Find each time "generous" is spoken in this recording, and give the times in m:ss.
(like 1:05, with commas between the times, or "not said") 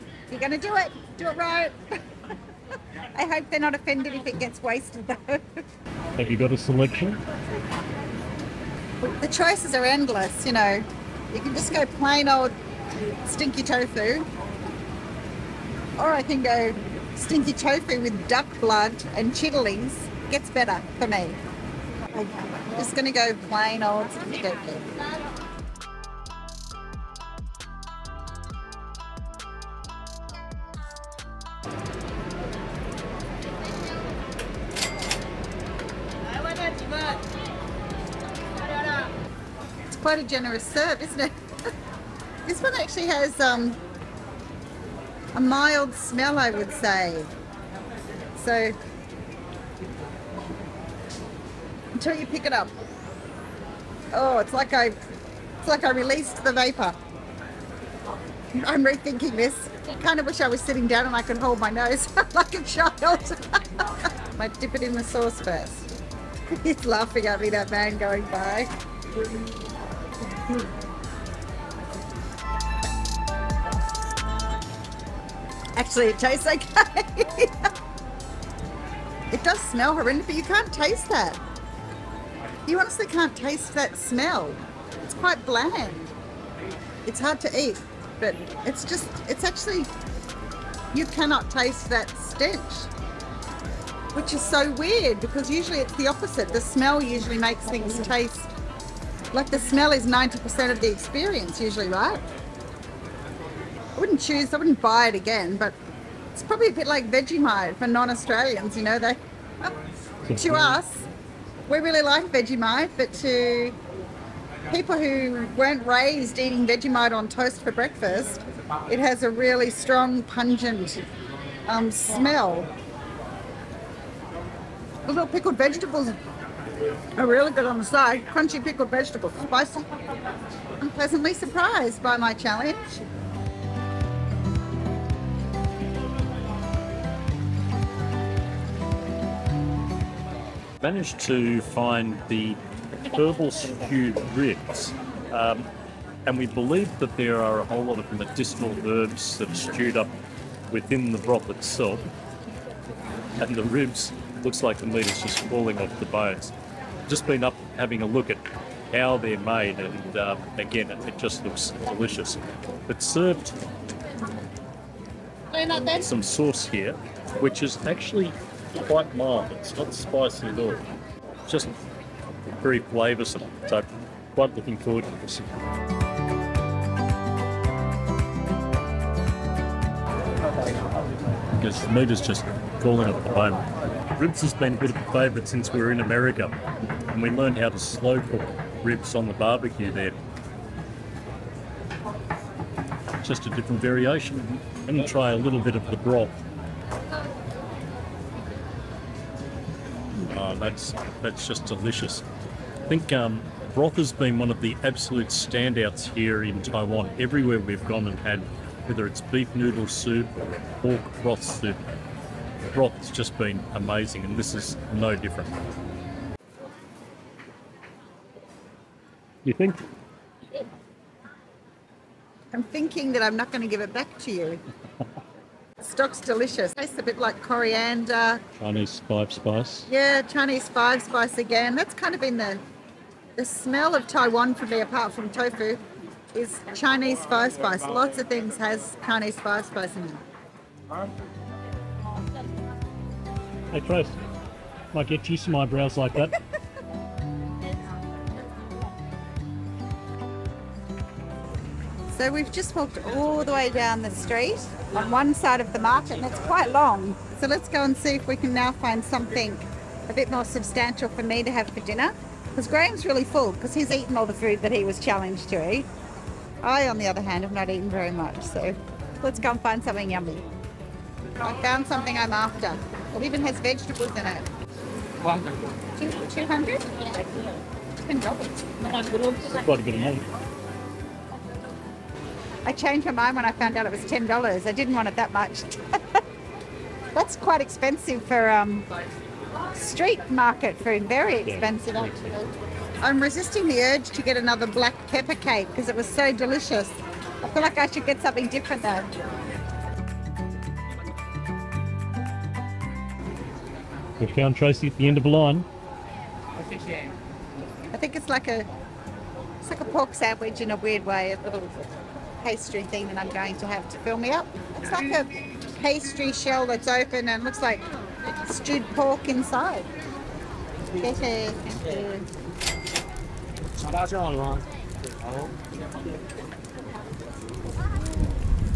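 0:40.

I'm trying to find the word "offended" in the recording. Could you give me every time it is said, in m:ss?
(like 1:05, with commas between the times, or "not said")
0:03.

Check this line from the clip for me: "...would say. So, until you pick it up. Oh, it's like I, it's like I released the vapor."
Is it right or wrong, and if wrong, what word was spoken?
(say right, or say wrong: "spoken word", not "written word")
right.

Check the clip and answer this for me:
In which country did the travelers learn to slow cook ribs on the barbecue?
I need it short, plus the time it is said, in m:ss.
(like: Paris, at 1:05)
America, at 3:06.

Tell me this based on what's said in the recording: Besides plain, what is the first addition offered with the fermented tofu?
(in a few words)
duck blood.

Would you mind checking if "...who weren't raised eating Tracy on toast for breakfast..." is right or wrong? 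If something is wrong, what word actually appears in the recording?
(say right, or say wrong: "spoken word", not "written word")
wrong: "Vegemite", not "Tracy".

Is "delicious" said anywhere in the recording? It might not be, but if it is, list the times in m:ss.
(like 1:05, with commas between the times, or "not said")
2:41, 3:21, 3:46, 4:56.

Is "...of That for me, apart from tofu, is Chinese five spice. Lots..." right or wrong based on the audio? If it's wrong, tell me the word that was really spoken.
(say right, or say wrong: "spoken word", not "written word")
wrong: "Taiwan", not "That".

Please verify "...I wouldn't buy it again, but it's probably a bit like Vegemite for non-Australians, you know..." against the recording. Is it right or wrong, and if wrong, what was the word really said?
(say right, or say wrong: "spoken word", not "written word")
right.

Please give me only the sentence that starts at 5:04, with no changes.
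We found Tracy at the end of a line.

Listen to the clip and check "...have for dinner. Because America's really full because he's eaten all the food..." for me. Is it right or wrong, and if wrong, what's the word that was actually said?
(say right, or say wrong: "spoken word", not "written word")
wrong: "Graham", not "America".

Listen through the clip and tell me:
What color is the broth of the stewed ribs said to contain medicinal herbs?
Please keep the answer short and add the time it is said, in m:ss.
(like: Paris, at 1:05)
purple, at 2:23.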